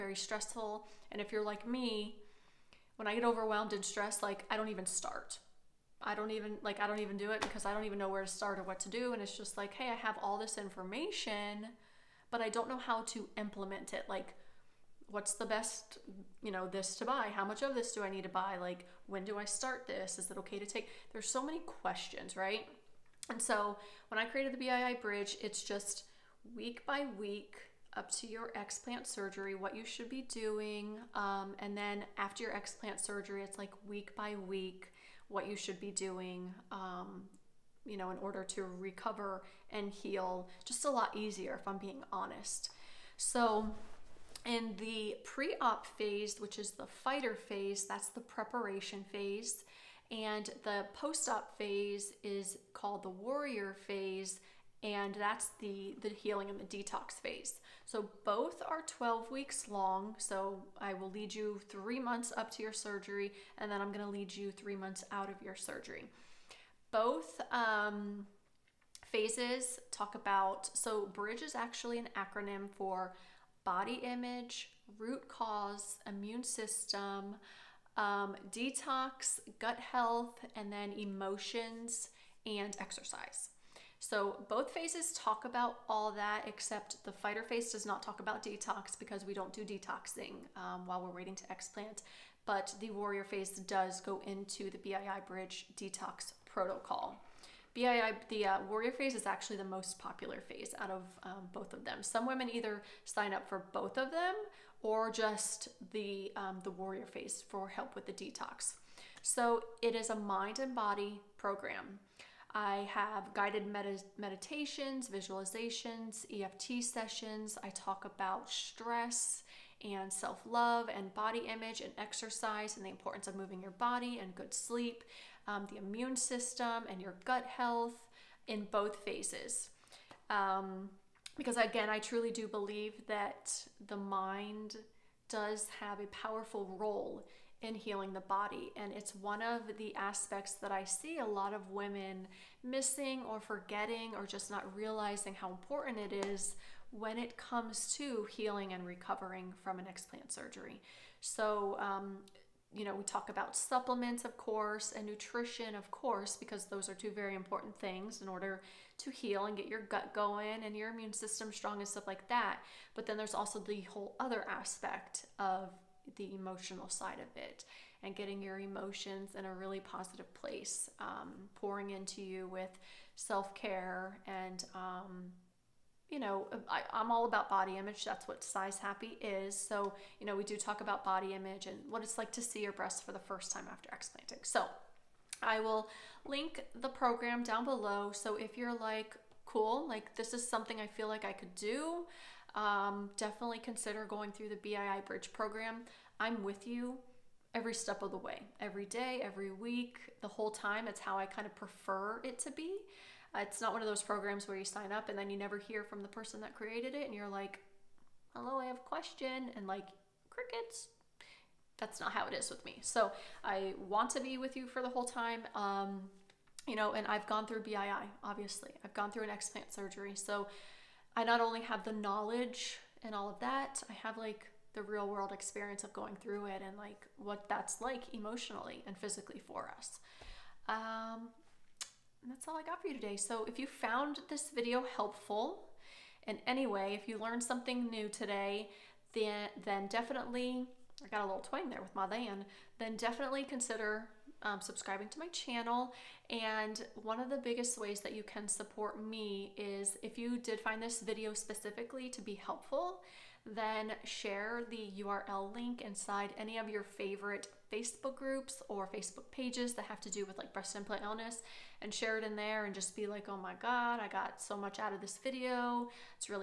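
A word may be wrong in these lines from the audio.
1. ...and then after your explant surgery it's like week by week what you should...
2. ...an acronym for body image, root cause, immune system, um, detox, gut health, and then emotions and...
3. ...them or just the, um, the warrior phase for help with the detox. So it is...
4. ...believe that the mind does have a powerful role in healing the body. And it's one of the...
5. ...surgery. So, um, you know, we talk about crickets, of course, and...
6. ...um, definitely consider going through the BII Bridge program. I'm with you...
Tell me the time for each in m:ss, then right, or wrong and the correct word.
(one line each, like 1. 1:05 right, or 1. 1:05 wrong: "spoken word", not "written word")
1. 0:31 right
2. 1:11 right
3. 1:44 right
4. 2:12 right
5. 2:30 wrong: "supplements", not "crickets"
6. 3:12 right.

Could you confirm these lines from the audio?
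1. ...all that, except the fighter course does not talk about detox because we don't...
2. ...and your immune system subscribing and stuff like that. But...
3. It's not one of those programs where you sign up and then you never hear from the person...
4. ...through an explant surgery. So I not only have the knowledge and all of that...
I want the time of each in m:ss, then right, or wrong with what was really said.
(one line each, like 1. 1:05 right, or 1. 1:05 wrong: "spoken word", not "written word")
1. 1:25 wrong: "phase", not "course"
2. 2:40 wrong: "strong", not "subscribing"
3. 3:23 right
4. 3:39 right.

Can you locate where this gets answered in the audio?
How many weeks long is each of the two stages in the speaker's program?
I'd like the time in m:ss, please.
0:58.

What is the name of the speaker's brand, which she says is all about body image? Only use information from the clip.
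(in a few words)
Size Happy.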